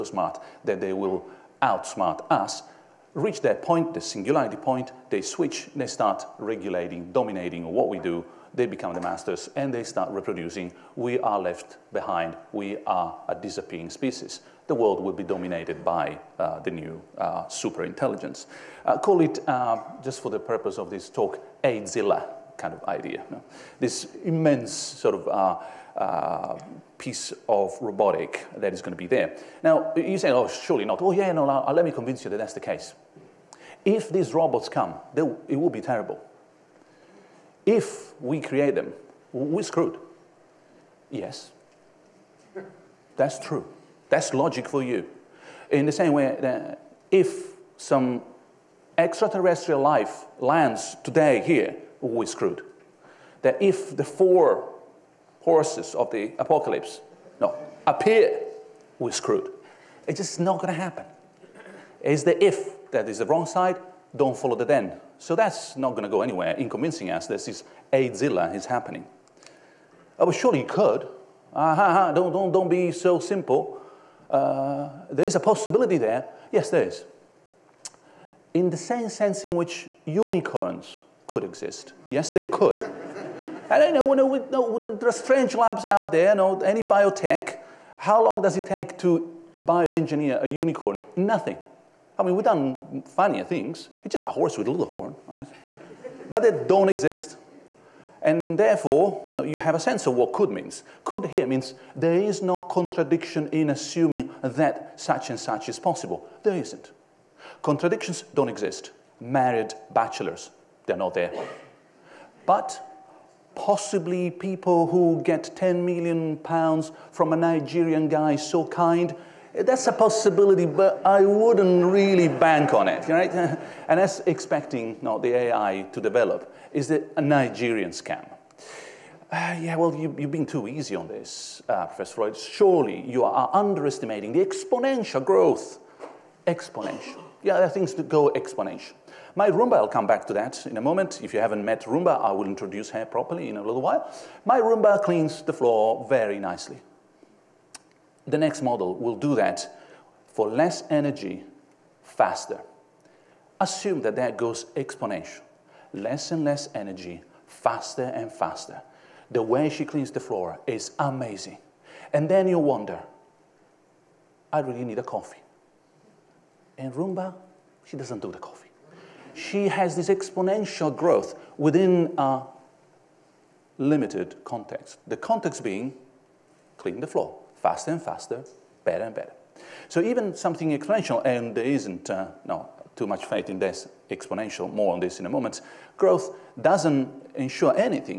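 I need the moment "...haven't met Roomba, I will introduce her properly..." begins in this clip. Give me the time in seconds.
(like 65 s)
141 s.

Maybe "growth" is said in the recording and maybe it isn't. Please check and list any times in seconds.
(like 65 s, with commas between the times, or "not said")
135 s, 170 s, 185 s.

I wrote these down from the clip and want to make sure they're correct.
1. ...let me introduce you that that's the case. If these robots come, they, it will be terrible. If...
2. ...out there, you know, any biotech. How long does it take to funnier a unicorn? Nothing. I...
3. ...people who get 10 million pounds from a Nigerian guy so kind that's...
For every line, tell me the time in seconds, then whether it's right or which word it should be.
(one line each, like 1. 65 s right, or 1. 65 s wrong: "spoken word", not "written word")
1. 31 s wrong: "convince", not "introduce"
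2. 85 s wrong: "bioengineer", not "funnier"
3. 114 s right.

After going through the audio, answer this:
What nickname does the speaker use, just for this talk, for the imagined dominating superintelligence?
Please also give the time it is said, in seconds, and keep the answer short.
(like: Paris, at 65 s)
Zilla, at 21 s.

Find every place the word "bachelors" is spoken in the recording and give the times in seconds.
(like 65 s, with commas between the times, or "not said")
109 s.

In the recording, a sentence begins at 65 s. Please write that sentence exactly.
So that's not going to go anywhere in convincing us this is Azilla is happening.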